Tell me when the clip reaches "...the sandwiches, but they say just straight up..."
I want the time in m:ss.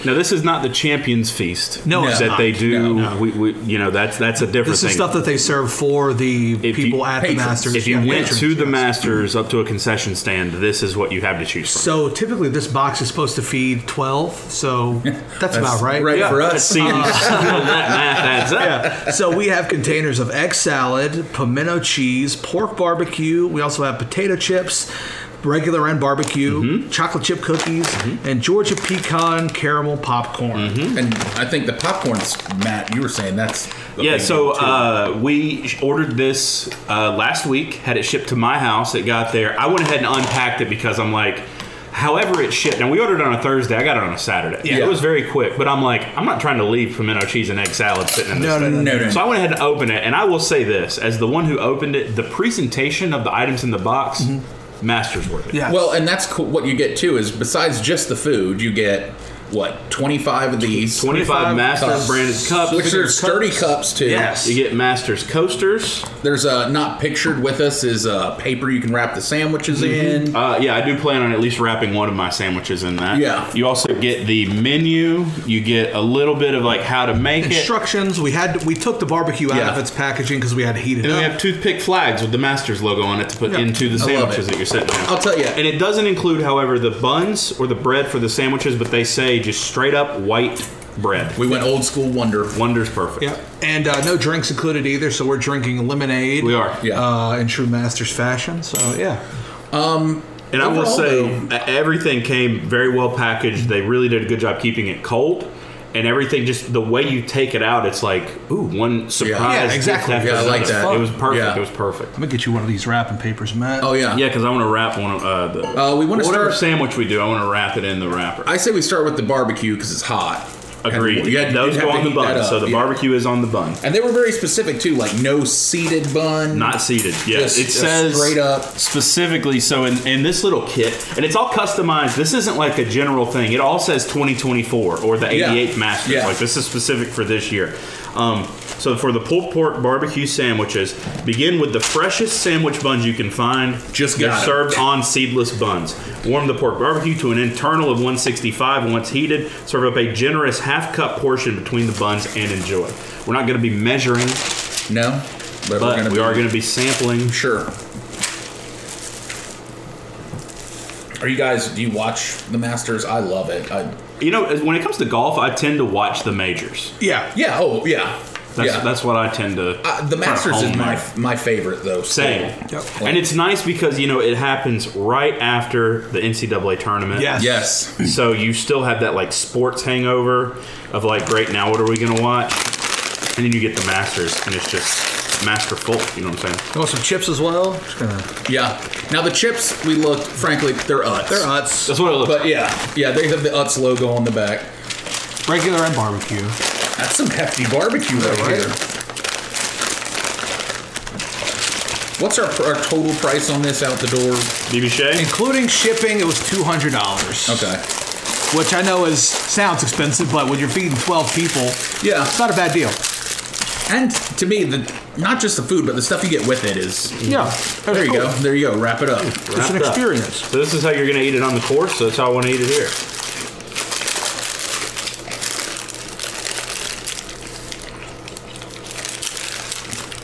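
1:28.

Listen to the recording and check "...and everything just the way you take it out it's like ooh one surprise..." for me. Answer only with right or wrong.
right.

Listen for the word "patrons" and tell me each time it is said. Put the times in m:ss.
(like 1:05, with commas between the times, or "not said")
0:07.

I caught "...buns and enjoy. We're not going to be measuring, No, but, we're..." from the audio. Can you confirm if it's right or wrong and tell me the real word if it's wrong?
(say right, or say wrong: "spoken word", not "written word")
right.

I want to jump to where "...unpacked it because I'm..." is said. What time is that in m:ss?
0:40.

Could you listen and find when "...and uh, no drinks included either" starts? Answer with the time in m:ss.
1:33.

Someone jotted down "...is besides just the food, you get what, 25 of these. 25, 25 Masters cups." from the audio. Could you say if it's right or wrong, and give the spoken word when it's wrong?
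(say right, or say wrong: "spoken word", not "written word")
right.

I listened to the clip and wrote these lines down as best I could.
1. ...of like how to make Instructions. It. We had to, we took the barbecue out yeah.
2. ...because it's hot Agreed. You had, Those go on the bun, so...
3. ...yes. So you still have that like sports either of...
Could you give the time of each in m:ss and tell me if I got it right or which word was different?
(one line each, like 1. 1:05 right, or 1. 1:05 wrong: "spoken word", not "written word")
1. 1:16 right
2. 1:59 right
3. 2:57 wrong: "hangover", not "either".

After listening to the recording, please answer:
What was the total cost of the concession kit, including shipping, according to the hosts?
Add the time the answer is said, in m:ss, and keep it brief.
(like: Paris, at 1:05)
$200, at 3:26.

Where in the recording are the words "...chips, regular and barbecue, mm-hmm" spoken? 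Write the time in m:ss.
0:24.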